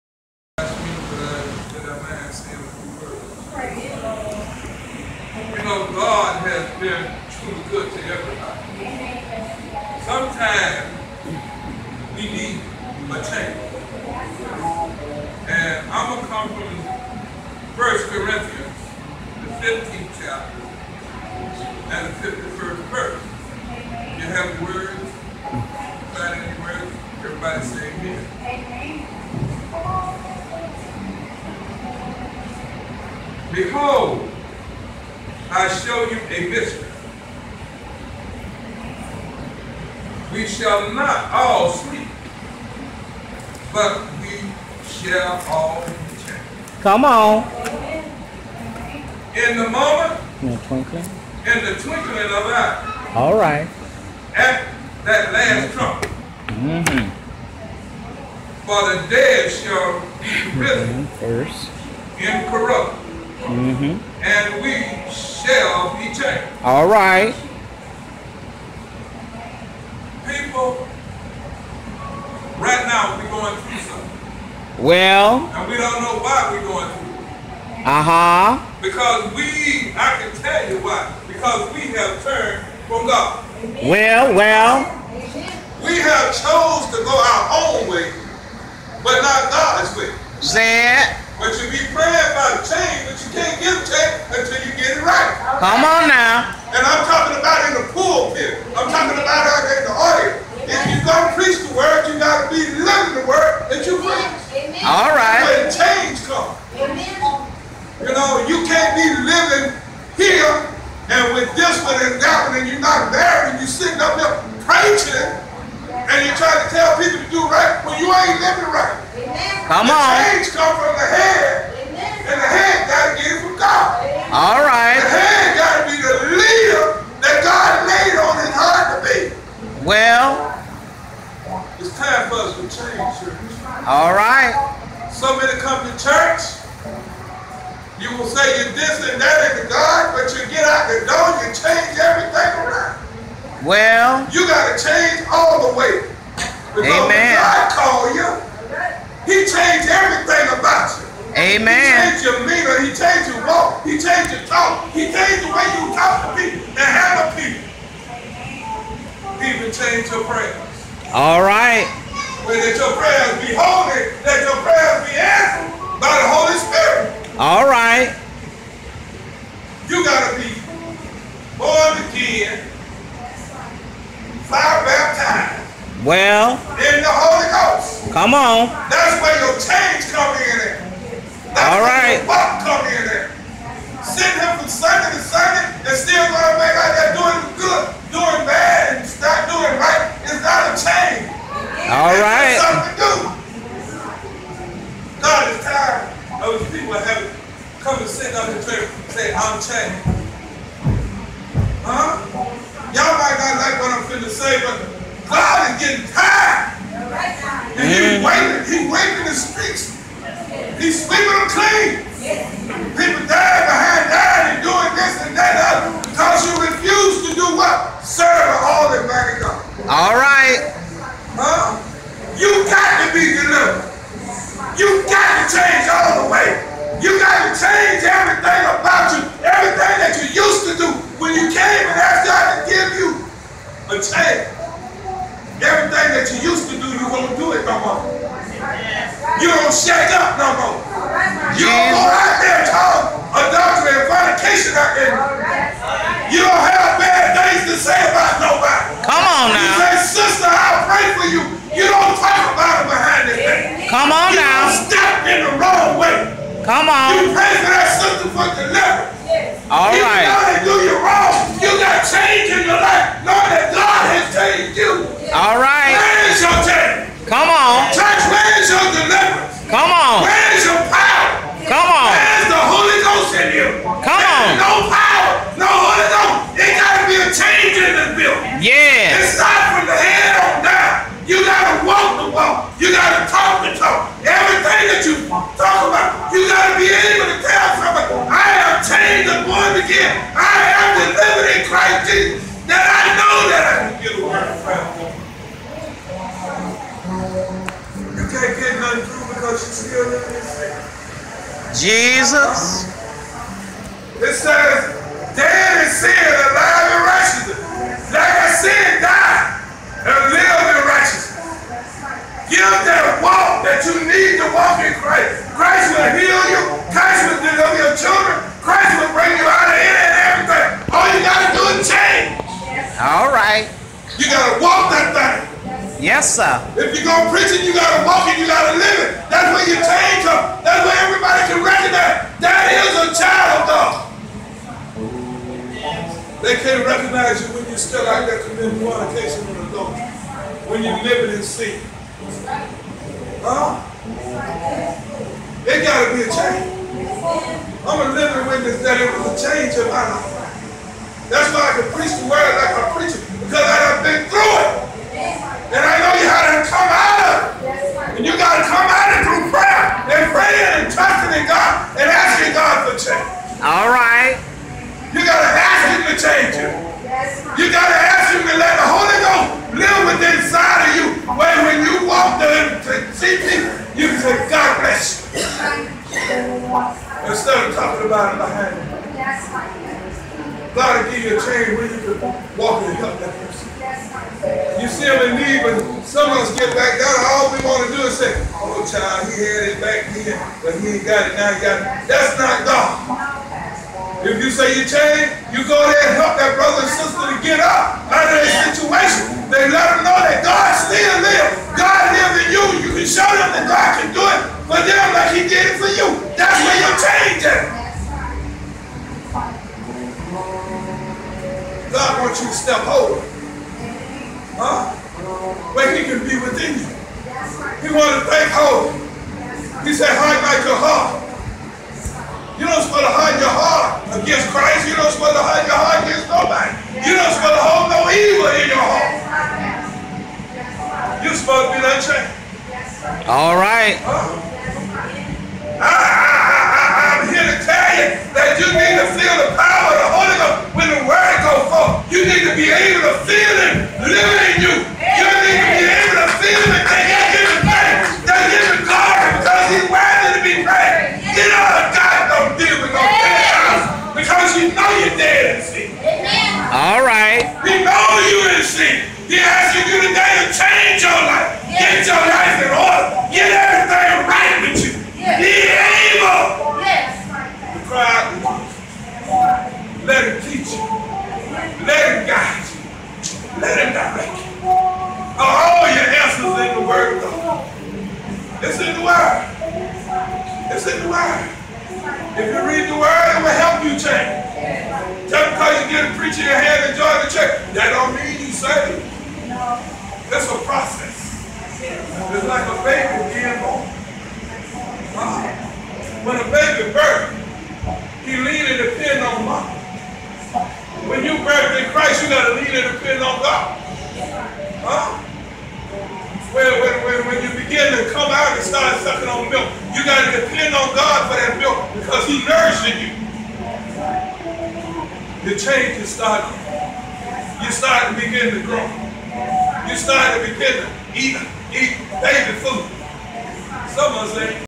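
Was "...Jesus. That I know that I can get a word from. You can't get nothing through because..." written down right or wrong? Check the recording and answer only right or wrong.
right.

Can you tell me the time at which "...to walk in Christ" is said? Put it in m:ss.
5:14.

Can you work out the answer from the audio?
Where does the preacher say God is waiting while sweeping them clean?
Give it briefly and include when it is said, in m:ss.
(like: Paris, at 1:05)
in the streets, at 3:29.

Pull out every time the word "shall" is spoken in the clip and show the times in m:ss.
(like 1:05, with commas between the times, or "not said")
0:40, 0:44, 0:59, 1:05.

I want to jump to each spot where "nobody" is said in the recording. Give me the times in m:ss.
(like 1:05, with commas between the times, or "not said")
4:08, 7:06.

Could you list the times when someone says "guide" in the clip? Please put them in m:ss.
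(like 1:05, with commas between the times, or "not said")
7:52.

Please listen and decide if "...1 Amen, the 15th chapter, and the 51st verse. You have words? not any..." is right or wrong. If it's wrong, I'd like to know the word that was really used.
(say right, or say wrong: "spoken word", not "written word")
wrong: "Corinthians", not "Amen".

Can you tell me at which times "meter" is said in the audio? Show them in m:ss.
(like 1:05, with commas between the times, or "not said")
2:32.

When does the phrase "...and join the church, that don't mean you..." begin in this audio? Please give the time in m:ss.
8:06.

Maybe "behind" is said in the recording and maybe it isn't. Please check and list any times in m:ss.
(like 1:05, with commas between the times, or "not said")
4:12, 6:18.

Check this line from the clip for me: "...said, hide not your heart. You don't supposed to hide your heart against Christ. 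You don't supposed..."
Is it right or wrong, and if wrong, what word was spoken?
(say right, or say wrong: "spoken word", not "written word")
right.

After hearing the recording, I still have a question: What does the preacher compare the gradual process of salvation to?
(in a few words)
a baby being born.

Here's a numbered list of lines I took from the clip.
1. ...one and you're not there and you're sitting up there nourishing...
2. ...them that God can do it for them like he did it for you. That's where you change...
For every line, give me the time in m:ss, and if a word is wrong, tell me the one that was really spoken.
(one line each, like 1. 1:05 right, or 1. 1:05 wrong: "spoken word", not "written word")
1. 1:52 wrong: "preaching", not "nourishing"
2. 6:43 right.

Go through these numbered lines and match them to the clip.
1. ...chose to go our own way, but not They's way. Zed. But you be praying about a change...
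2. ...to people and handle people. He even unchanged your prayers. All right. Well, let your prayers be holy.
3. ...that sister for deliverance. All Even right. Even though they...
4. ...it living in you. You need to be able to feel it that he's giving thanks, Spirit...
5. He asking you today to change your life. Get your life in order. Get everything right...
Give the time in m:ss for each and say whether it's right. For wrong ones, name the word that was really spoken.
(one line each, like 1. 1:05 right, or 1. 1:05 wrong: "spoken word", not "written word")
1. 1:26 wrong: "God", not "They"
2. 2:36 wrong: "changed", not "unchanged"
3. 4:17 right
4. 7:23 wrong: "They", not "Spirit"
5. 7:39 right.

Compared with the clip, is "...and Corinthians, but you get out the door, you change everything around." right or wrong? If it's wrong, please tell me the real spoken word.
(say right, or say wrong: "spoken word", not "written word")
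wrong: "God", not "Corinthians".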